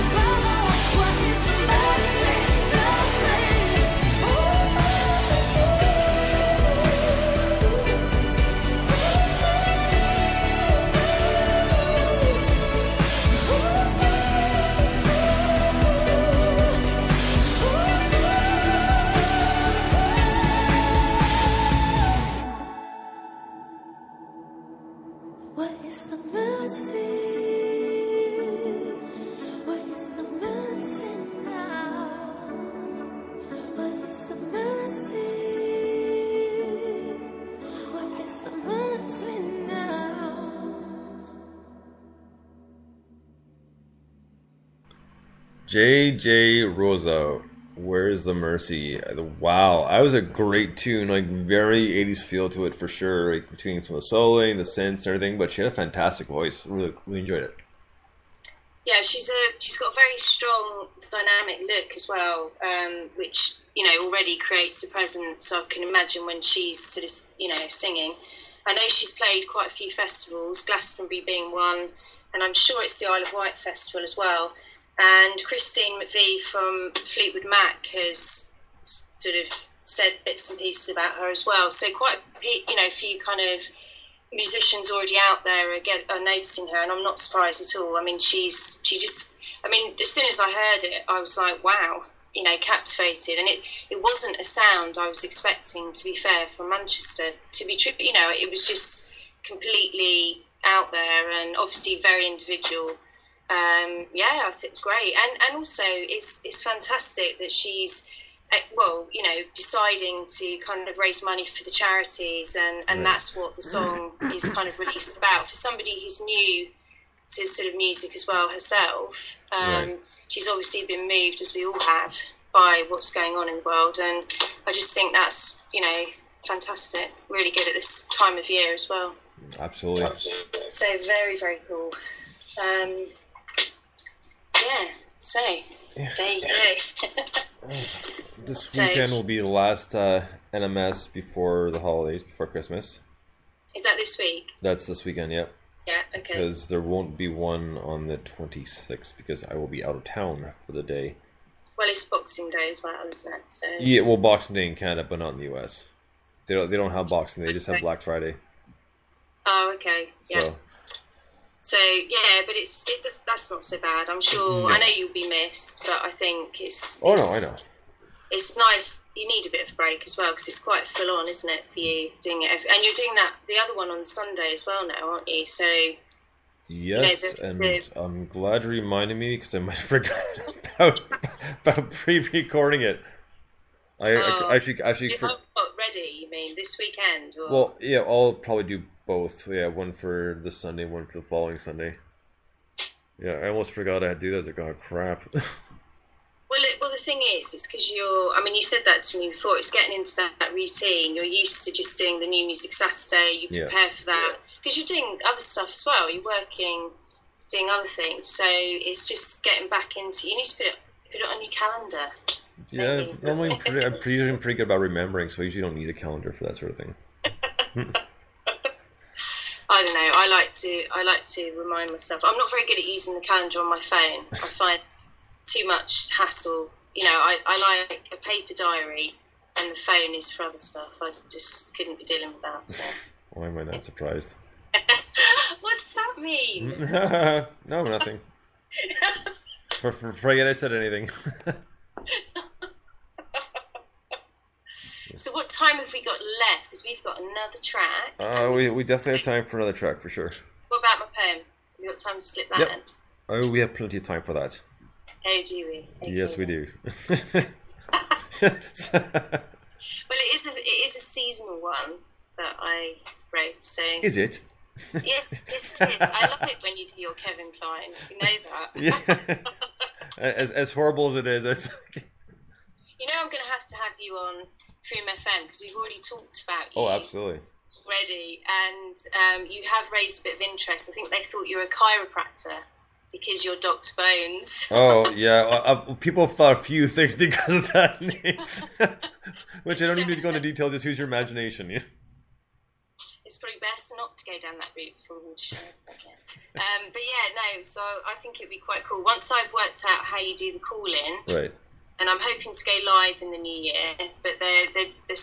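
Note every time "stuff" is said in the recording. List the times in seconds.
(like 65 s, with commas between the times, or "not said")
205 s, 230 s.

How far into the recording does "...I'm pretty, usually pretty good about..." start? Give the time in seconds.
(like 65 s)
213 s.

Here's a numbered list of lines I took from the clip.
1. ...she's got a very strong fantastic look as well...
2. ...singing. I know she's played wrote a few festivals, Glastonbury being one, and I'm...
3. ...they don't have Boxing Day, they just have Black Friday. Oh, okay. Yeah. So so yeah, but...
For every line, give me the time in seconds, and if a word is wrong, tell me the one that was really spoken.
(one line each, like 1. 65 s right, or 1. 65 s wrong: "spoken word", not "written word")
1. 59 s wrong: "dynamic", not "fantastic"
2. 67 s wrong: "quite", not "wrote"
3. 156 s right.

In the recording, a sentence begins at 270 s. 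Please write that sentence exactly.
as as horrible as it is, it's.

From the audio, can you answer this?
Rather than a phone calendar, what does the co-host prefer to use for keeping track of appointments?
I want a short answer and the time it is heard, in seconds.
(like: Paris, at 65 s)
Paper diary, at 228 s.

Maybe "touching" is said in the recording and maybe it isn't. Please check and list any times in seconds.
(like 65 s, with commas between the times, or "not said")
not said.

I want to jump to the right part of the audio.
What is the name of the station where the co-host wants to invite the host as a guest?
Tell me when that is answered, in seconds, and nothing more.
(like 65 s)
274 s.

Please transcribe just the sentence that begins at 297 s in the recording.
So I think it'd be quite cool once I've worked out how you do the call in.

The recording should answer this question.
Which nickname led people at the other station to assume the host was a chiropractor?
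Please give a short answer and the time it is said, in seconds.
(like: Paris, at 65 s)
Doctor Bones, at 283 s.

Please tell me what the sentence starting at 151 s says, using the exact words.
Well, it's Boxing Day as well, isn't it?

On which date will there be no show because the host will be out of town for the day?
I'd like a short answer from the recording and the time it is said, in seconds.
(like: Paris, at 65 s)
26th, at 148 s.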